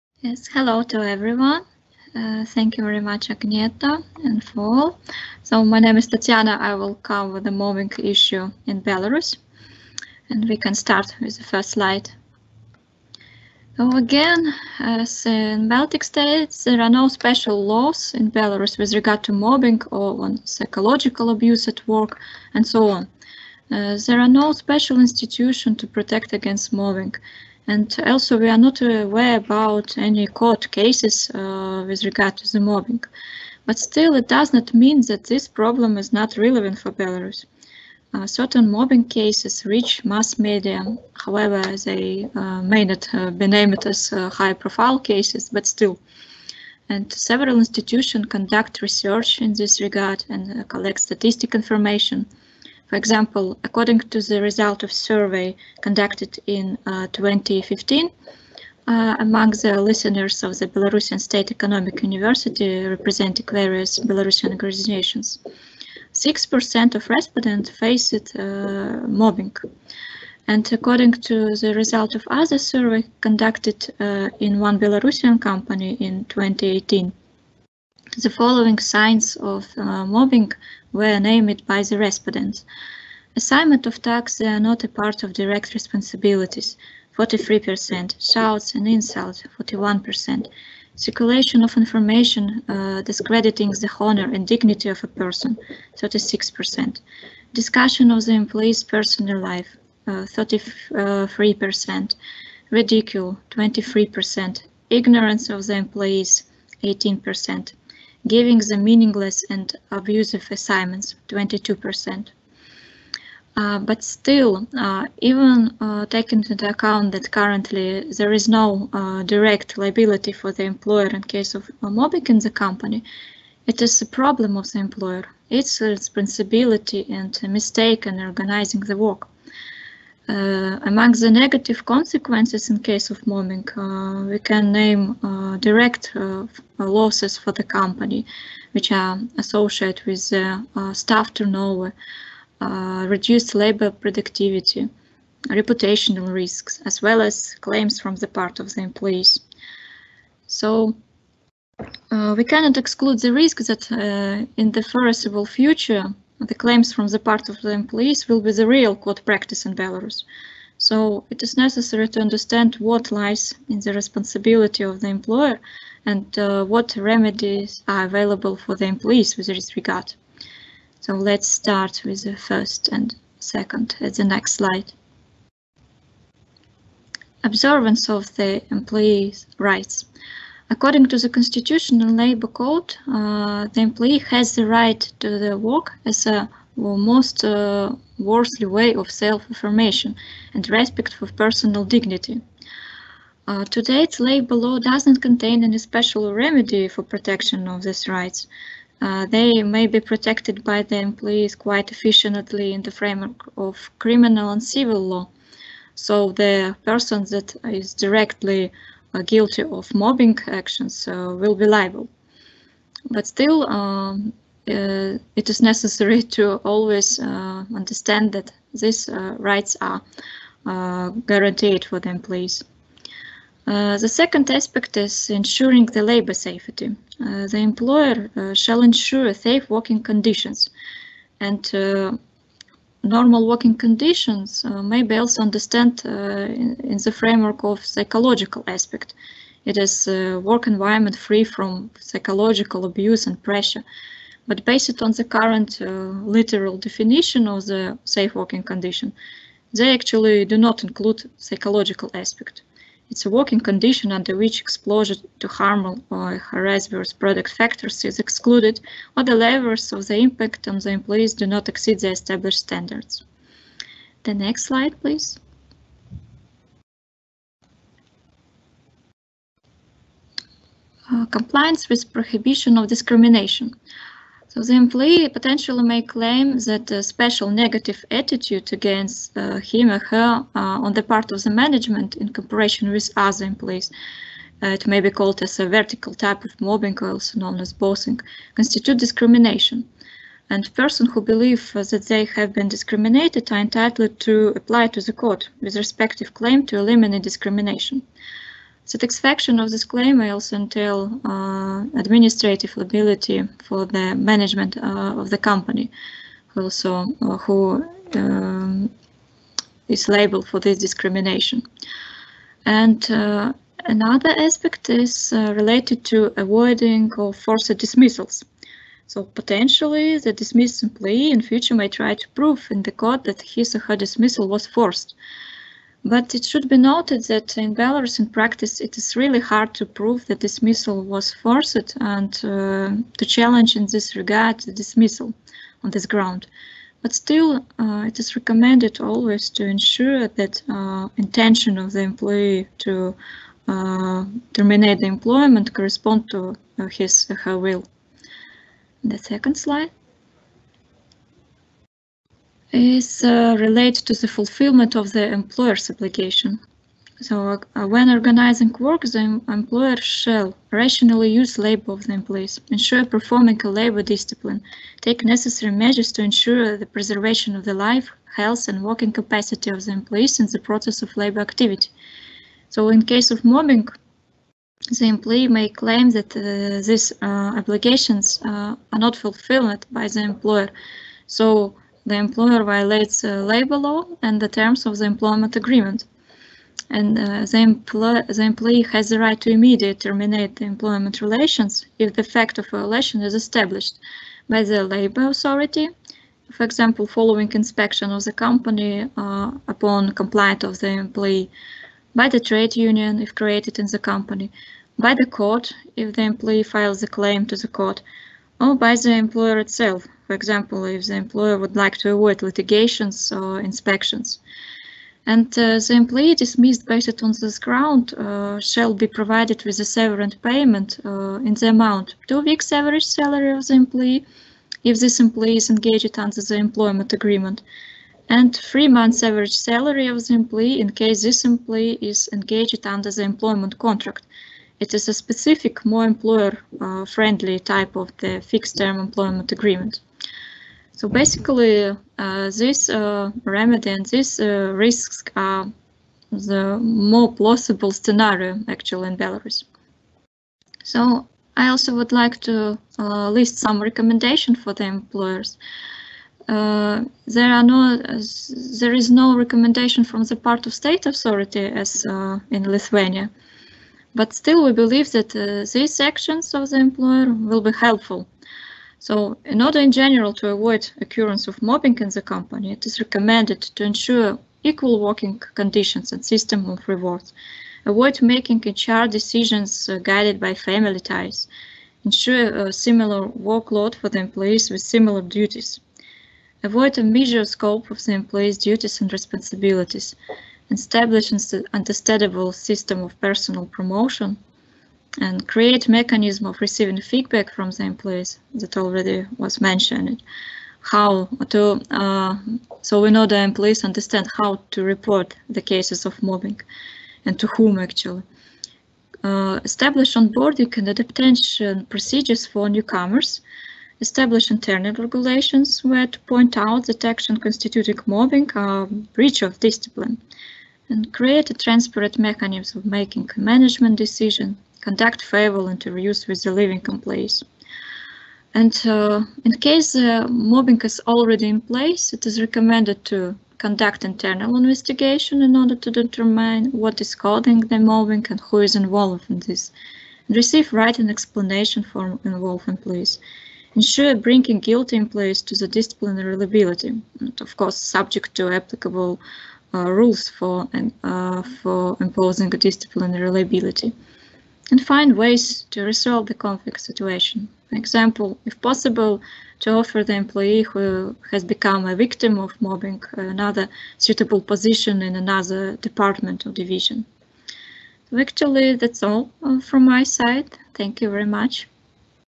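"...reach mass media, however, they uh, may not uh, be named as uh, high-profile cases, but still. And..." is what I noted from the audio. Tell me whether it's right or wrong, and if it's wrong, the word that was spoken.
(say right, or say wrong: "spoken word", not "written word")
right.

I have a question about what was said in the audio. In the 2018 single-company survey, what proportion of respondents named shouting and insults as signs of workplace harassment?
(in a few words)
41%.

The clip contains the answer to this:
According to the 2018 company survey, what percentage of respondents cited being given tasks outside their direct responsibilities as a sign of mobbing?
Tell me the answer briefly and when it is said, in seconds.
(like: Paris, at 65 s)
43%, at 87 s.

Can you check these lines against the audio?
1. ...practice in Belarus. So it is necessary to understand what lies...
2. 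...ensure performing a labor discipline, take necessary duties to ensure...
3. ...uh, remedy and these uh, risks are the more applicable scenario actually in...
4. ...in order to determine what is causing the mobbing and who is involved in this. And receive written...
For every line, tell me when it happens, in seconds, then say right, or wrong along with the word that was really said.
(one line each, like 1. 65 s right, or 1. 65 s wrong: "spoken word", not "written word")
1. 159 s right
2. 362 s wrong: "measures", not "duties"
3. 442 s wrong: "plausible", not "applicable"
4. 535 s right.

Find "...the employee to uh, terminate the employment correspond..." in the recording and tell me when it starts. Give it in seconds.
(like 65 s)
341 s.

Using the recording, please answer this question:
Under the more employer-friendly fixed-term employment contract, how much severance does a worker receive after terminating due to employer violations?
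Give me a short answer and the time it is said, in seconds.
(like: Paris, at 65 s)
3 months average salary, at 428 s.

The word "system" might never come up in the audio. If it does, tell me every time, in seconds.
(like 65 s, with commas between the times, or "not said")
476 s, 492 s.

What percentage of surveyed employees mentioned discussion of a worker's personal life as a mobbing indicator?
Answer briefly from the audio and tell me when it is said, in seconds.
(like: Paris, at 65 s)
33%, at 100 s.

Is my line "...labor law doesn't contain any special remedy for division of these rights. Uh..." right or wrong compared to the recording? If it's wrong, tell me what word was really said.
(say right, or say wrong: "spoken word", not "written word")
wrong: "protection", not "division".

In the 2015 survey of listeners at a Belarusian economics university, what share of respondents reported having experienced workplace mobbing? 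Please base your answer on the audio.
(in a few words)
6%.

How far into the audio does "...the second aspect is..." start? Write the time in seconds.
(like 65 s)
223 s.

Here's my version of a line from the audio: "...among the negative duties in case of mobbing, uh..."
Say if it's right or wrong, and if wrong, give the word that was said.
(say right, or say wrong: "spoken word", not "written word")
wrong: "consequences", not "duties".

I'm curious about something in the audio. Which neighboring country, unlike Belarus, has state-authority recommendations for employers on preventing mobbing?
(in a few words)
Lithuania.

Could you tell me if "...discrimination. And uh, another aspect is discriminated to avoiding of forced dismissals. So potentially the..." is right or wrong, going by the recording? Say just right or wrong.
wrong.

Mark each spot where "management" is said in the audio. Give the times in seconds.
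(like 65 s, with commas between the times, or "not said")
281 s, 304 s, 523 s.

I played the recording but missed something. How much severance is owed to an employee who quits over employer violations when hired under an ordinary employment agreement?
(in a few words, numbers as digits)
2 weeks average salary.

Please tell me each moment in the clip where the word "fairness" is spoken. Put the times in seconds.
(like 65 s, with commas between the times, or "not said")
not said.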